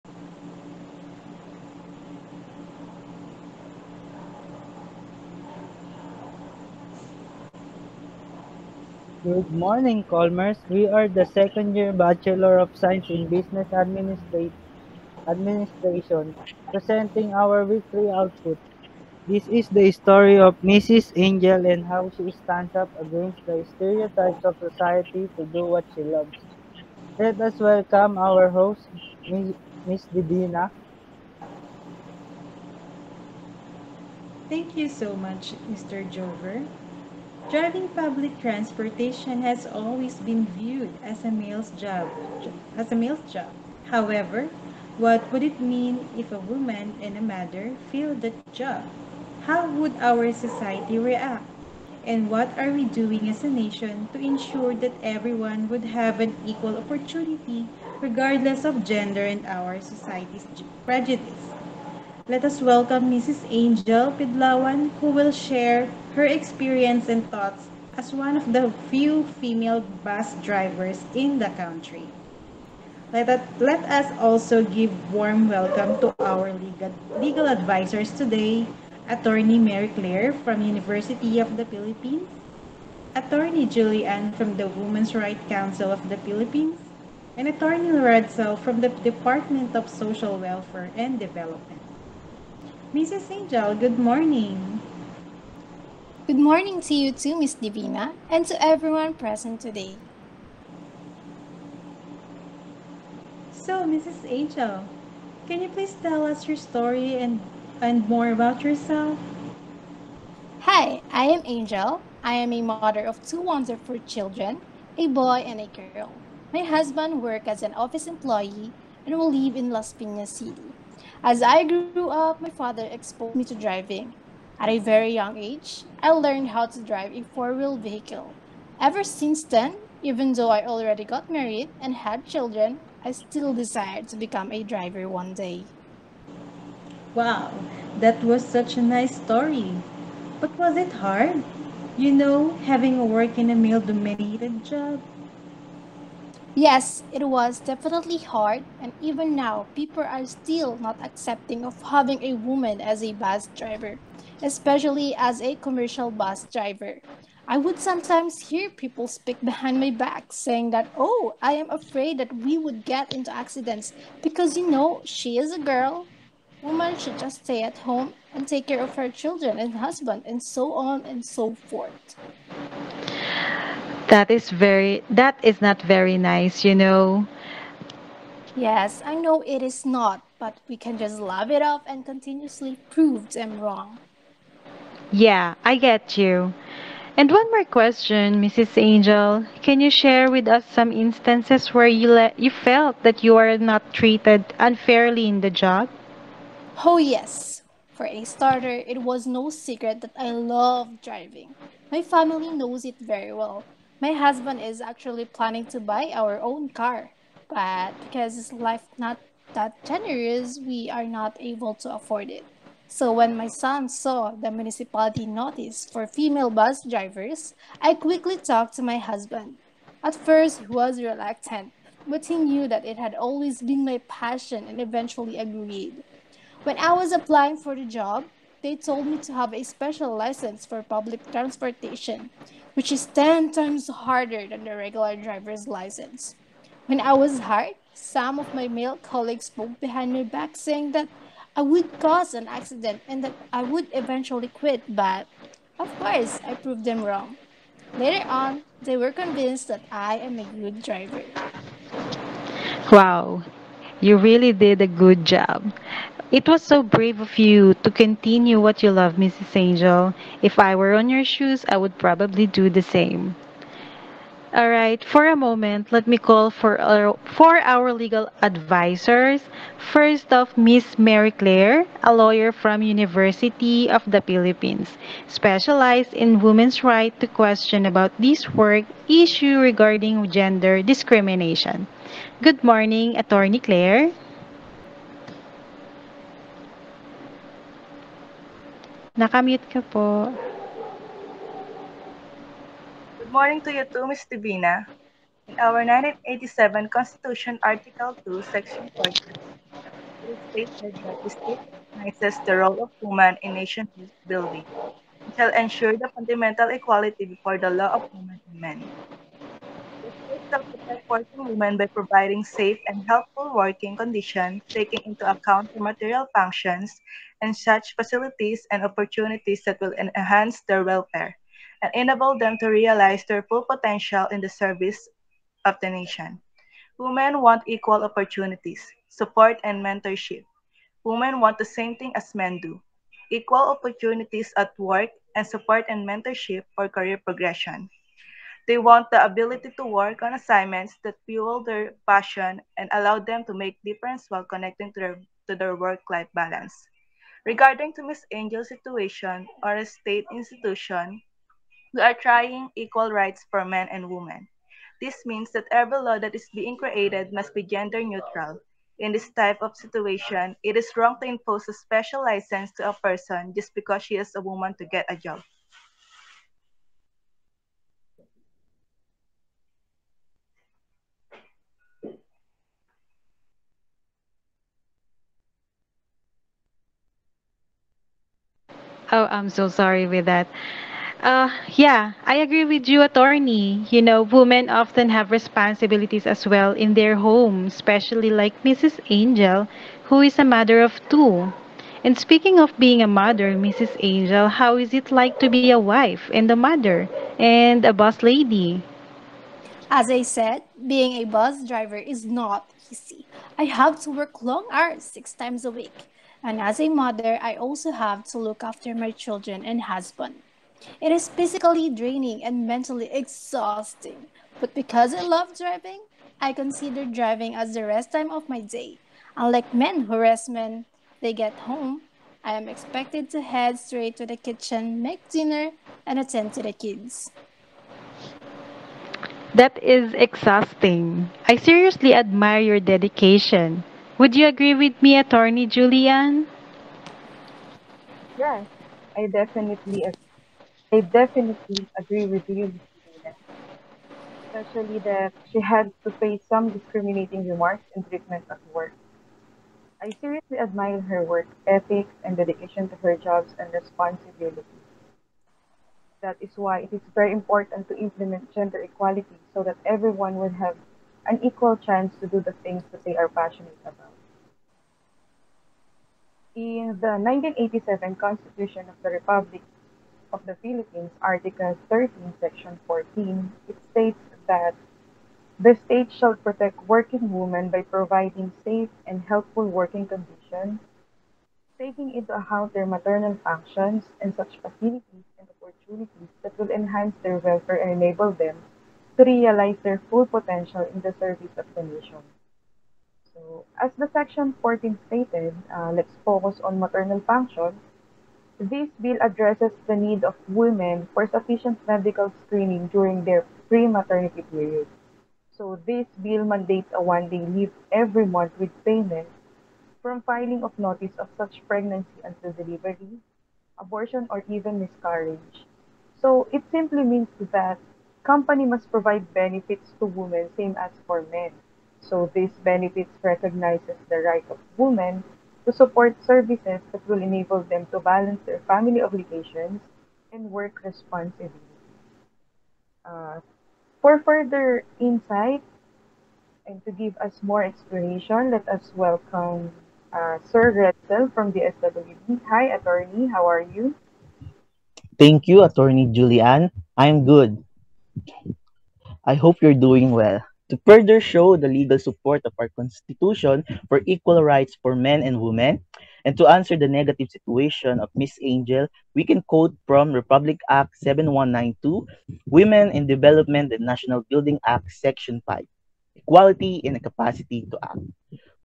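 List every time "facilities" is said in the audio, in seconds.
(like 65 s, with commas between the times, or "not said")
317 s, 484 s.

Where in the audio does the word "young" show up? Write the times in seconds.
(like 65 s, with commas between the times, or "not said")
125 s.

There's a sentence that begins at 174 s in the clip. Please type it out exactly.
That is very that is not very nice, you know.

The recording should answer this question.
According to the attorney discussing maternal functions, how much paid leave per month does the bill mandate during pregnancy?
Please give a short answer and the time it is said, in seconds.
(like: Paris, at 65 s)
1 day, at 507 s.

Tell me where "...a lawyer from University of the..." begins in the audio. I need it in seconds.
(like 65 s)
272 s.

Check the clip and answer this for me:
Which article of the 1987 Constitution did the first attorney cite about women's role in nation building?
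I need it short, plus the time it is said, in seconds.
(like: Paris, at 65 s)
Article 2, at 297 s.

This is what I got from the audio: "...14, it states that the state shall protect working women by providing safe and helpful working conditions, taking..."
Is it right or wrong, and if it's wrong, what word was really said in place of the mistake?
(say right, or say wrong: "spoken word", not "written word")
right.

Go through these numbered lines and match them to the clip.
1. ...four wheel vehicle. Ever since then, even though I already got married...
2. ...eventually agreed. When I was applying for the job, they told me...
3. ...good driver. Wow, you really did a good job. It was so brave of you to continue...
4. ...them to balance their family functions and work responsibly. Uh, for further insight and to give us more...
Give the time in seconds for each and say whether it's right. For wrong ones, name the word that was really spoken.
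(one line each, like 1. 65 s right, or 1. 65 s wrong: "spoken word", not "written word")
1. 127 s right
2. 224 s right
3. 250 s right
4. 527 s wrong: "obligations", not "functions".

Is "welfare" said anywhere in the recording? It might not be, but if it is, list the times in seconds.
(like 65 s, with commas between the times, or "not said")
90 s, 320 s, 487 s.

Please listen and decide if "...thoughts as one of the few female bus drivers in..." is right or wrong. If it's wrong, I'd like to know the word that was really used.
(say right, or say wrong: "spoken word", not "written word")
right.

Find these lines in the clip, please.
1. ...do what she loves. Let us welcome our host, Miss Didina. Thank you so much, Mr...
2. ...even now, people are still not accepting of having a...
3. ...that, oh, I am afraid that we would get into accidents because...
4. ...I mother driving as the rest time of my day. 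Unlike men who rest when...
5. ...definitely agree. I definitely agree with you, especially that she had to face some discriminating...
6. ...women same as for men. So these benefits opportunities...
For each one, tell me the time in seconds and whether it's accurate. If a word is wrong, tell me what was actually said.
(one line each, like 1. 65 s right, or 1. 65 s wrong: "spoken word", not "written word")
1. 25 s right
2. 148 s right
3. 160 s right
4. 416 s wrong: "consider", not "mother"
5. 439 s right
6. 520 s wrong: "recognizes", not "opportunities".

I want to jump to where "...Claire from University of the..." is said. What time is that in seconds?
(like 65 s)
79 s.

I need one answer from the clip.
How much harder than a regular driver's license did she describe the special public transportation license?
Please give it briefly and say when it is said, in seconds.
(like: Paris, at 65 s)
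10 times, at 233 s.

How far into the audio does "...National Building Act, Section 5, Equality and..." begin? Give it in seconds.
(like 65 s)
563 s.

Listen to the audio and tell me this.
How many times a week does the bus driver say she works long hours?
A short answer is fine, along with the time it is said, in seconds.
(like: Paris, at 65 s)
6, at 405 s.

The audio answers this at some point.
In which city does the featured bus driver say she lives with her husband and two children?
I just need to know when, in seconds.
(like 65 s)
119 s.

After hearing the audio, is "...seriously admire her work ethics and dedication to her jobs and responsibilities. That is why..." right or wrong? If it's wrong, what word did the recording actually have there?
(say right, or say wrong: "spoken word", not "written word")
right.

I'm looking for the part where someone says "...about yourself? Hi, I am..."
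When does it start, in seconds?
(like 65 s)
108 s.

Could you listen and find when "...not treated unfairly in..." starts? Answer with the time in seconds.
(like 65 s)
193 s.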